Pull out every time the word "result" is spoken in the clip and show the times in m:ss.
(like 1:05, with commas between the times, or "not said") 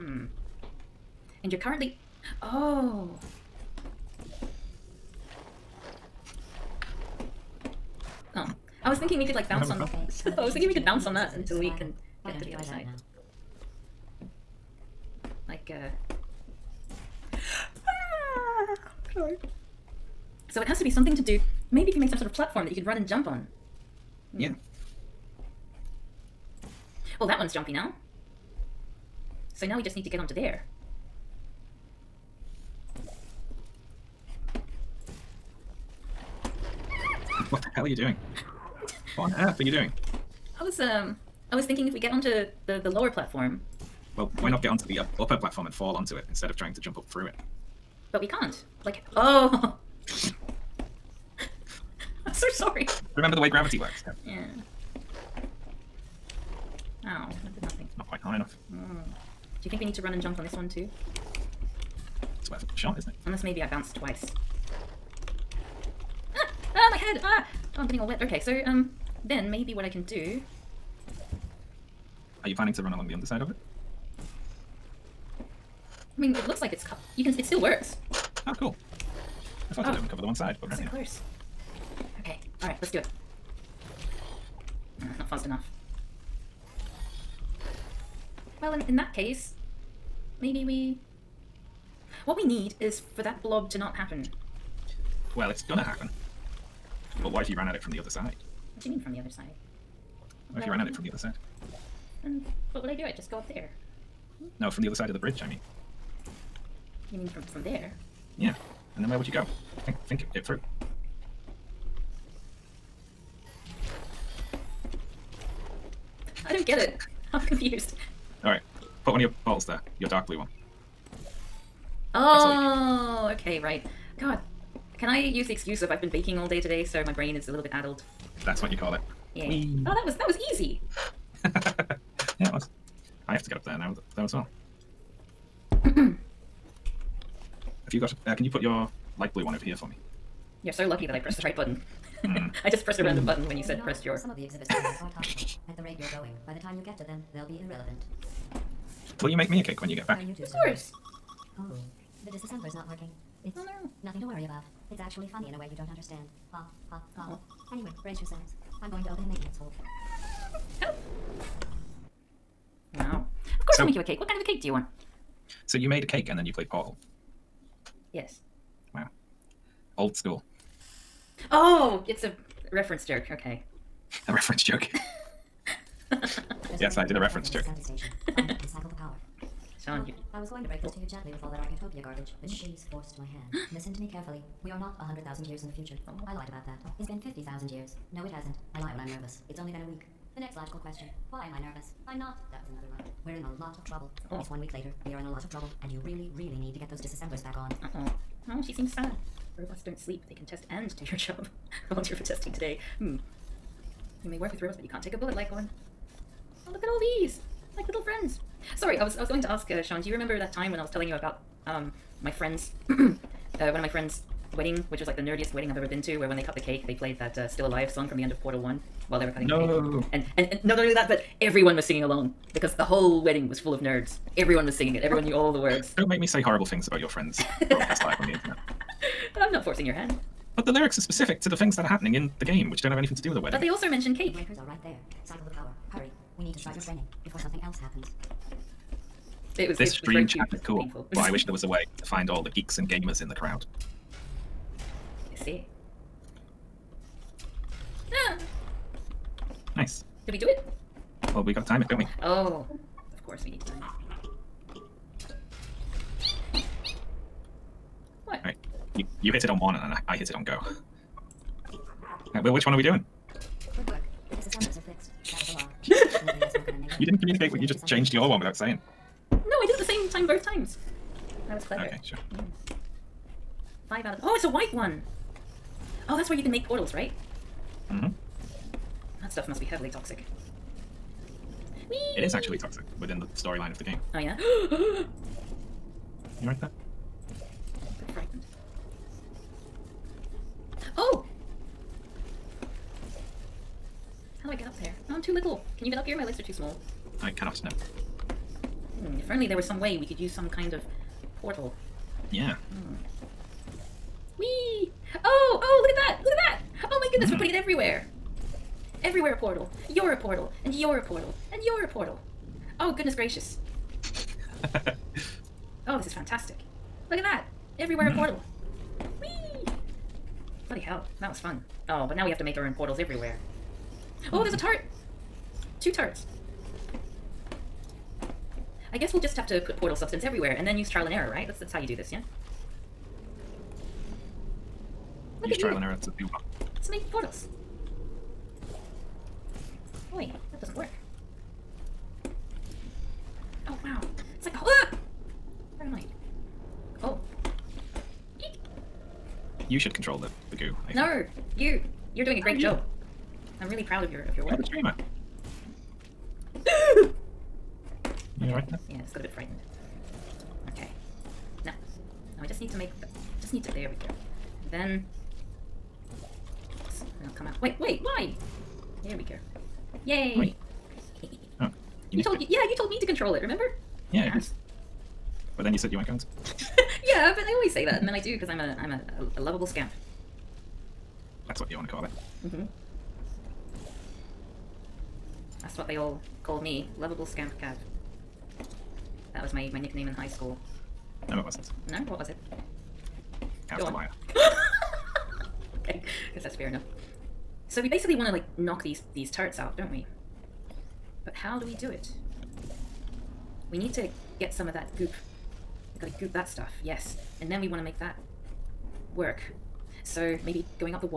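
not said.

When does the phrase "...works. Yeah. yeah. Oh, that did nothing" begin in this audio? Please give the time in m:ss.
0:53.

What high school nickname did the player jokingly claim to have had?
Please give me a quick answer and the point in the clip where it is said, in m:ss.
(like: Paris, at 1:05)
lovable scamp Kav, at 6:26.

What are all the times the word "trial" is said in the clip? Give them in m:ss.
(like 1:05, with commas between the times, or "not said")
5:30, 5:35.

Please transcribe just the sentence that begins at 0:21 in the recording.
Maybe if you made some sort of platform that you could run and jump on.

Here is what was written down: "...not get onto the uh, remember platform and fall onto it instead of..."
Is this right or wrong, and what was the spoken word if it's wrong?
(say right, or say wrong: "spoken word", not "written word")
wrong: "upper", not "remember".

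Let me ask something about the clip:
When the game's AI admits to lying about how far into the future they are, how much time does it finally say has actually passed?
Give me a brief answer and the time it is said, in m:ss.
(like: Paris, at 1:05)
a week, at 3:09.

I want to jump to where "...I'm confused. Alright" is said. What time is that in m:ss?
1:57.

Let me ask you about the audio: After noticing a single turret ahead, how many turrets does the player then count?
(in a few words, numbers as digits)
2.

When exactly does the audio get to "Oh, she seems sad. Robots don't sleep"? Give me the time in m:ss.
3:18.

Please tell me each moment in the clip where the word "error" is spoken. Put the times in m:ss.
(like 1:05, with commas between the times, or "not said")
5:31, 5:35.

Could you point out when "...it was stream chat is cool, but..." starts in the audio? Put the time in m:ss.
3:59.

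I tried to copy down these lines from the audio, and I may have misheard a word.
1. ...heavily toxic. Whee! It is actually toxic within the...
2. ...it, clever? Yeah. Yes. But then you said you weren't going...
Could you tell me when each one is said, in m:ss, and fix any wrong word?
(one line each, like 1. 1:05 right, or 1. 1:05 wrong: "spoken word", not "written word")
1. 4:39 right
2. 6:13 wrong: "remember", not "clever".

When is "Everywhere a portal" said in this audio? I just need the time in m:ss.
5:09.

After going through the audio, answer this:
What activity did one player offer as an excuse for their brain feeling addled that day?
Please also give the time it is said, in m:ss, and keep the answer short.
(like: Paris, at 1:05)
baking, at 2:06.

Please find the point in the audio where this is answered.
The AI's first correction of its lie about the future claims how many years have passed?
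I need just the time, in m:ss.
3:07.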